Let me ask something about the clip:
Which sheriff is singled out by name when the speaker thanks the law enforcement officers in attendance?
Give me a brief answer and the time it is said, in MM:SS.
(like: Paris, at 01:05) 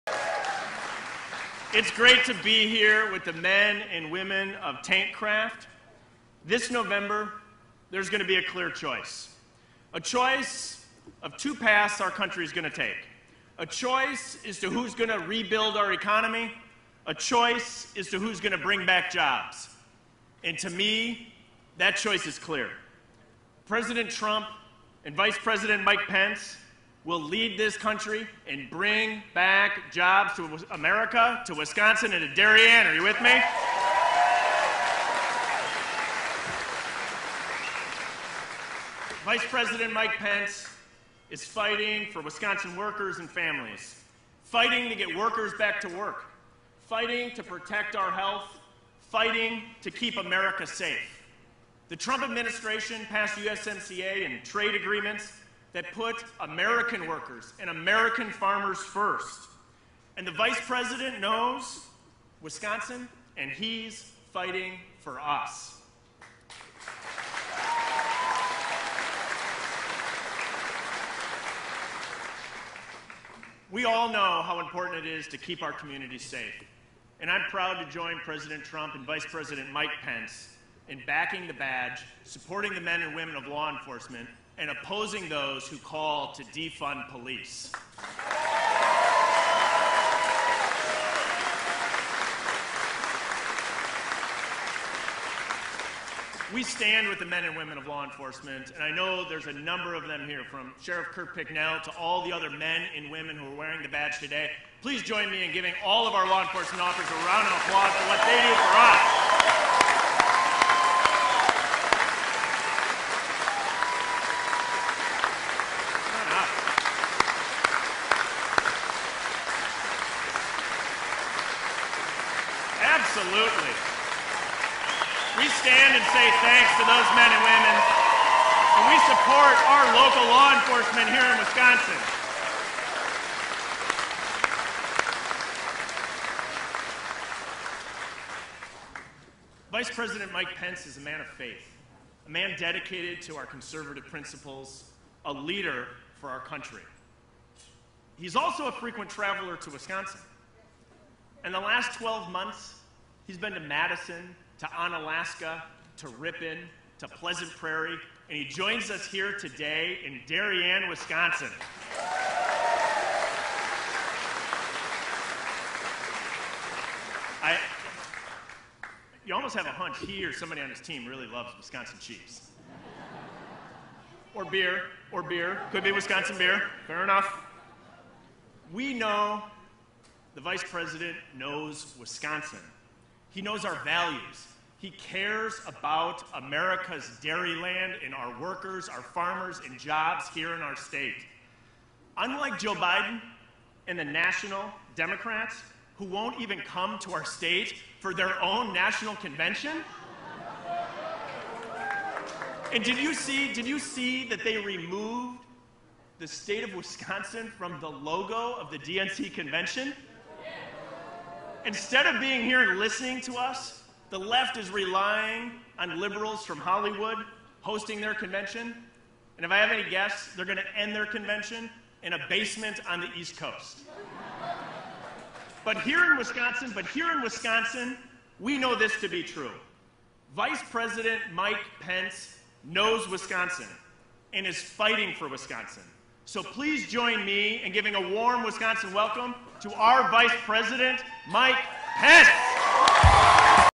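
Kurt Picknell, at 01:41.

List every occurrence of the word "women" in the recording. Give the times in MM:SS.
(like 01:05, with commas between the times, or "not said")
00:04, 01:23, 01:37, 01:43, 02:07.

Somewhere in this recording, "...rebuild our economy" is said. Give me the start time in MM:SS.
00:15.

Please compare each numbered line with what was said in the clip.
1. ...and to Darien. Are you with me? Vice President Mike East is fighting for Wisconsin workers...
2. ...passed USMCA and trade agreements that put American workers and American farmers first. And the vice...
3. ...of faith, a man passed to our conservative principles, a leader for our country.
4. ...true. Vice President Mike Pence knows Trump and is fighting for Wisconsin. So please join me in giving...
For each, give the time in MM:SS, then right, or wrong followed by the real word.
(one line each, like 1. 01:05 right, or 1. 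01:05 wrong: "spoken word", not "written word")
1. 00:32 wrong: "Pence", not "East"
2. 00:53 right
3. 02:21 wrong: "dedicated", not "passed"
4. 03:49 wrong: "Wisconsin", not "Trump".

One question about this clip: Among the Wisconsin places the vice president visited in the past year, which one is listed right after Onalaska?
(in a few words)
Ripon.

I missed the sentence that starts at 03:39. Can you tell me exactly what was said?
And if I have any guess, they're going to end their convention in a basement on the East Coast.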